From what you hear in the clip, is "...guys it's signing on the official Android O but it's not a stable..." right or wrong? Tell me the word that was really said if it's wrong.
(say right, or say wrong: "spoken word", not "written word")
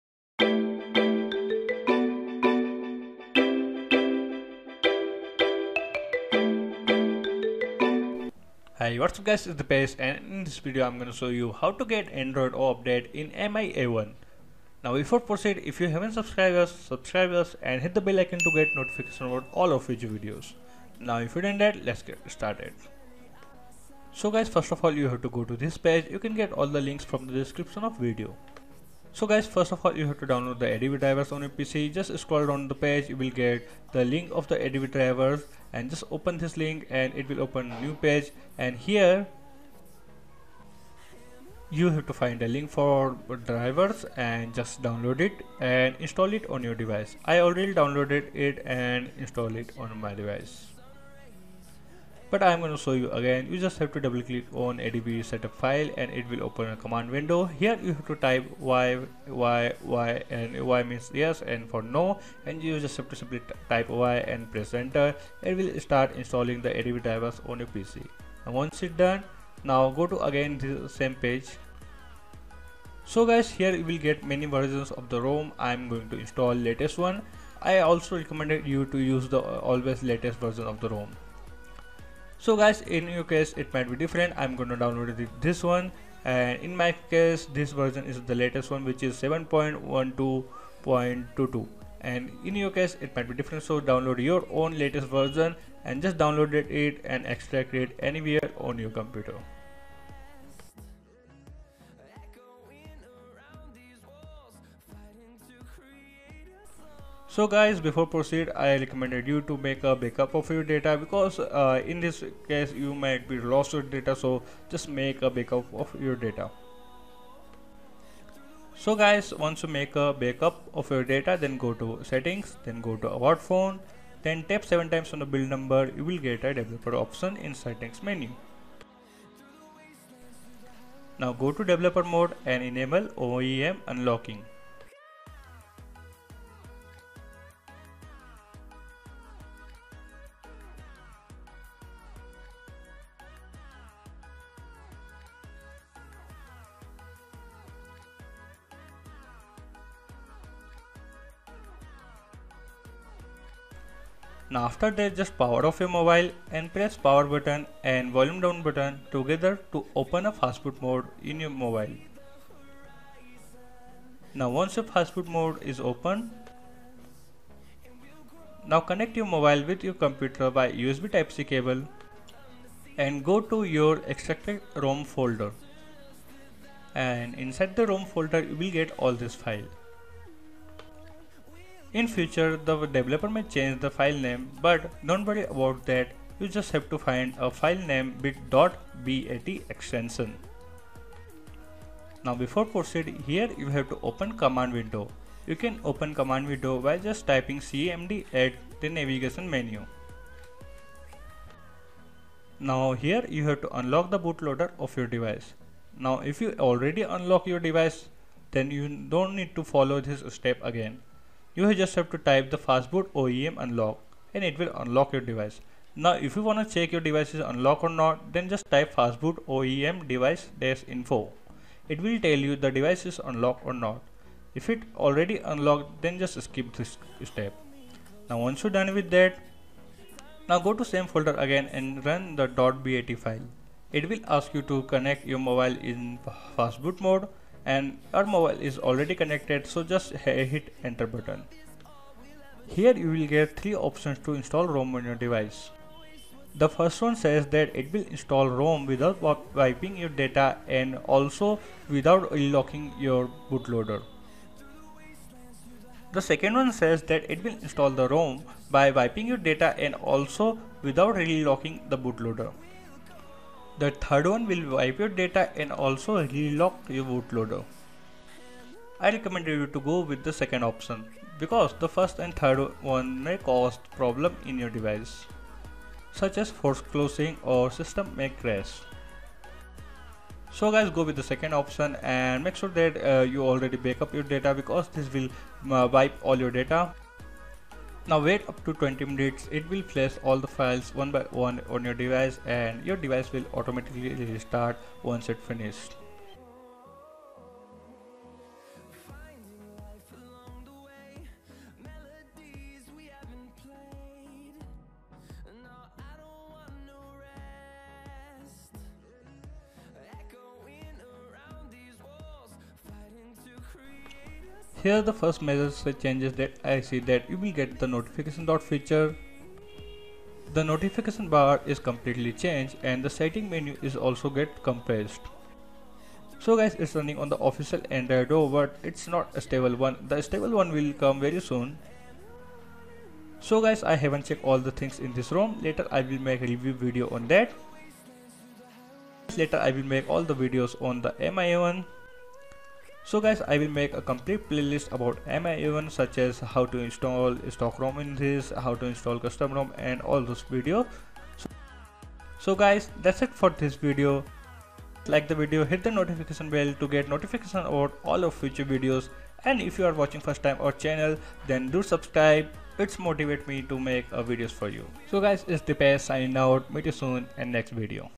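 wrong: "running", not "signing".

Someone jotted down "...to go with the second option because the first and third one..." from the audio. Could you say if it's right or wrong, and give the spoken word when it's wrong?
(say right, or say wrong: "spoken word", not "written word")
right.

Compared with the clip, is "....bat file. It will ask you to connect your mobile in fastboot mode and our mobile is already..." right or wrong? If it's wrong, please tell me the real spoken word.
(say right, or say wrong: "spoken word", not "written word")
right.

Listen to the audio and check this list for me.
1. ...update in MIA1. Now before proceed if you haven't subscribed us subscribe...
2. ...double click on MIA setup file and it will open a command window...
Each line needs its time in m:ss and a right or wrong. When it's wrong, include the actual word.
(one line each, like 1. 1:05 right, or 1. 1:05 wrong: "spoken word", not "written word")
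1. 0:12 right
2. 0:54 wrong: "ADB", not "MIA".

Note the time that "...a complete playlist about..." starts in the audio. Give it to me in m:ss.
5:43.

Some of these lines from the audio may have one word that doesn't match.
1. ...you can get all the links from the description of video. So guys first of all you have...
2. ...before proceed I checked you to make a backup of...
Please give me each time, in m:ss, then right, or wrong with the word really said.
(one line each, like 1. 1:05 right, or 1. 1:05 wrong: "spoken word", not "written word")
1. 0:26 right
2. 1:47 wrong: "recommended", not "checked".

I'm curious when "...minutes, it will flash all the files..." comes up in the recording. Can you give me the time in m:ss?
4:49.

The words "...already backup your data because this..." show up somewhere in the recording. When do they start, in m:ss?
4:43.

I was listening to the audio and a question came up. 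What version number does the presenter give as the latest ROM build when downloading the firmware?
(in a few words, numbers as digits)
7.12.22.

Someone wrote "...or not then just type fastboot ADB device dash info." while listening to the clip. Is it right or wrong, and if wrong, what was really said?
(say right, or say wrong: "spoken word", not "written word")
wrong: "OEM", not "ADB".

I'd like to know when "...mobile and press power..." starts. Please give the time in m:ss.
2:35.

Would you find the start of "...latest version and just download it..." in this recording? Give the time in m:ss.
1:34.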